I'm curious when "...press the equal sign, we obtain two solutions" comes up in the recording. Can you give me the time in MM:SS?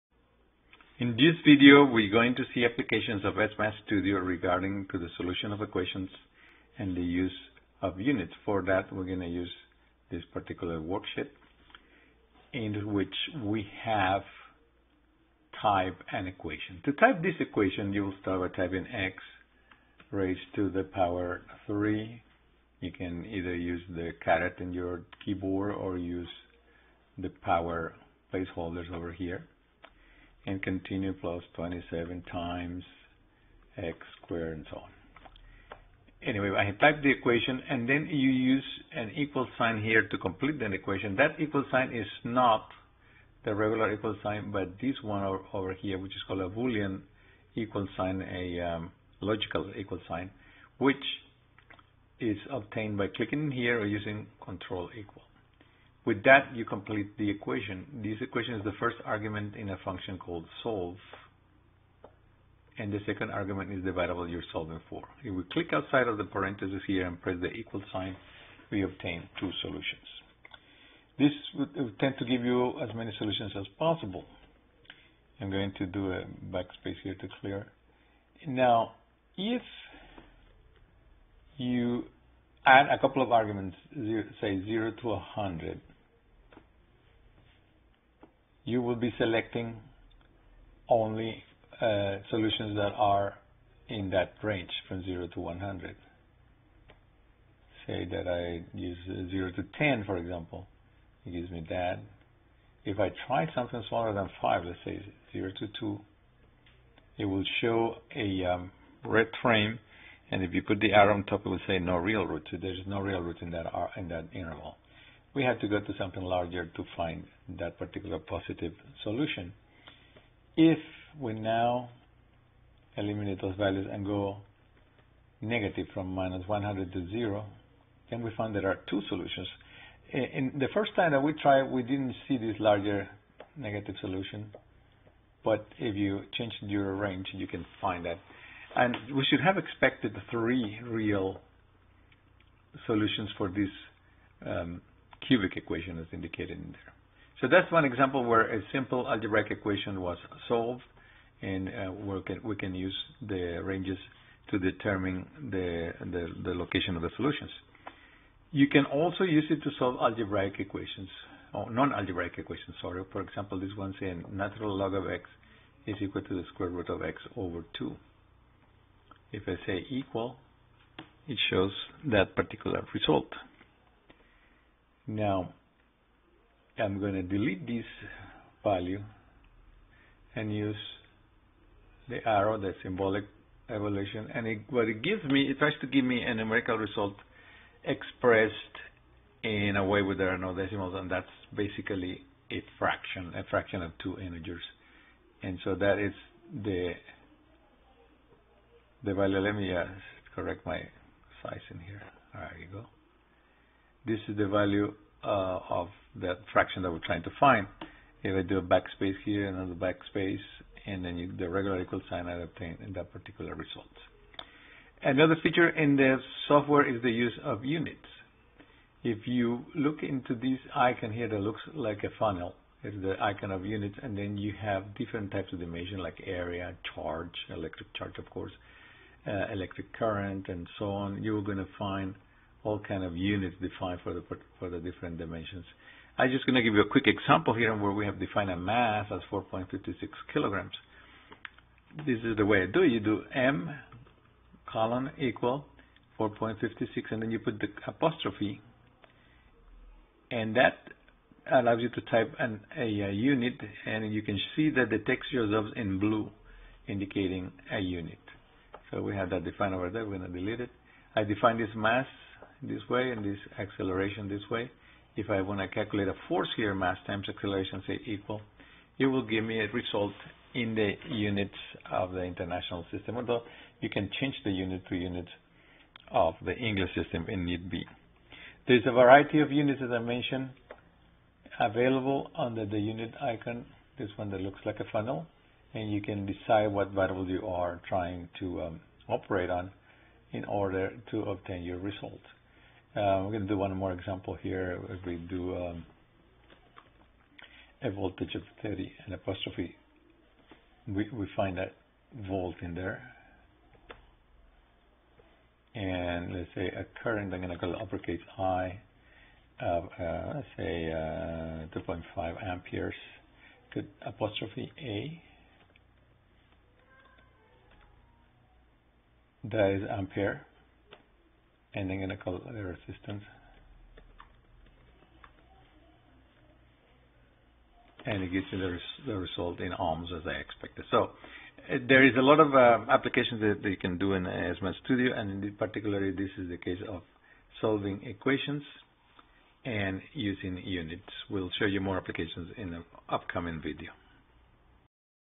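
01:07.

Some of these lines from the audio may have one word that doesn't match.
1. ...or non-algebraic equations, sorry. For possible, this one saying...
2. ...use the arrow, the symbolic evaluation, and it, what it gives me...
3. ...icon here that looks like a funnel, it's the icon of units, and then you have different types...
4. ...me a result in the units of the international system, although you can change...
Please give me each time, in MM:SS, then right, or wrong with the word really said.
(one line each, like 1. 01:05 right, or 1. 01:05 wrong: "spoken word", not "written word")
1. 02:41 wrong: "example", not "possible"
2. 03:00 right
3. 03:40 right
4. 04:29 right.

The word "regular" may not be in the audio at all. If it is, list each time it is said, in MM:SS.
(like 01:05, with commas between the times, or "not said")
00:43, 03:31.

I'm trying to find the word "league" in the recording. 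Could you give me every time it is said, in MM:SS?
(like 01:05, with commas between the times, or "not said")
not said.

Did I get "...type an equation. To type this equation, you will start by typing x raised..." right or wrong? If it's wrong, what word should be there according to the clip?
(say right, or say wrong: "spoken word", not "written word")
right.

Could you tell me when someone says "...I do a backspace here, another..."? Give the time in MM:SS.
03:28.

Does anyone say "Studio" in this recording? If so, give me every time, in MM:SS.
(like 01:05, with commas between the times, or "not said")
00:03, 05:34.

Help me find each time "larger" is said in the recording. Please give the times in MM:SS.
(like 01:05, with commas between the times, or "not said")
01:56, 02:12.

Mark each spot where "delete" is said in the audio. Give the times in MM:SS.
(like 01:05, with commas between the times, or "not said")
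02:57, 04:20.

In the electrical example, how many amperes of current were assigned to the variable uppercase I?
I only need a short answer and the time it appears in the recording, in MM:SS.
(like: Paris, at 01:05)
2.5, at 05:11.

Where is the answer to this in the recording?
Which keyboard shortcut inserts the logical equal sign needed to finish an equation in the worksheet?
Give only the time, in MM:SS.
00:54.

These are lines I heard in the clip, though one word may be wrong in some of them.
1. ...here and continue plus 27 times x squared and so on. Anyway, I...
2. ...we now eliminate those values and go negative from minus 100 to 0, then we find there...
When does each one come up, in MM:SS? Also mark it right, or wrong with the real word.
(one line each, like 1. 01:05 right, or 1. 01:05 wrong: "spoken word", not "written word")
1. 00:29 right
2. 02:01 right.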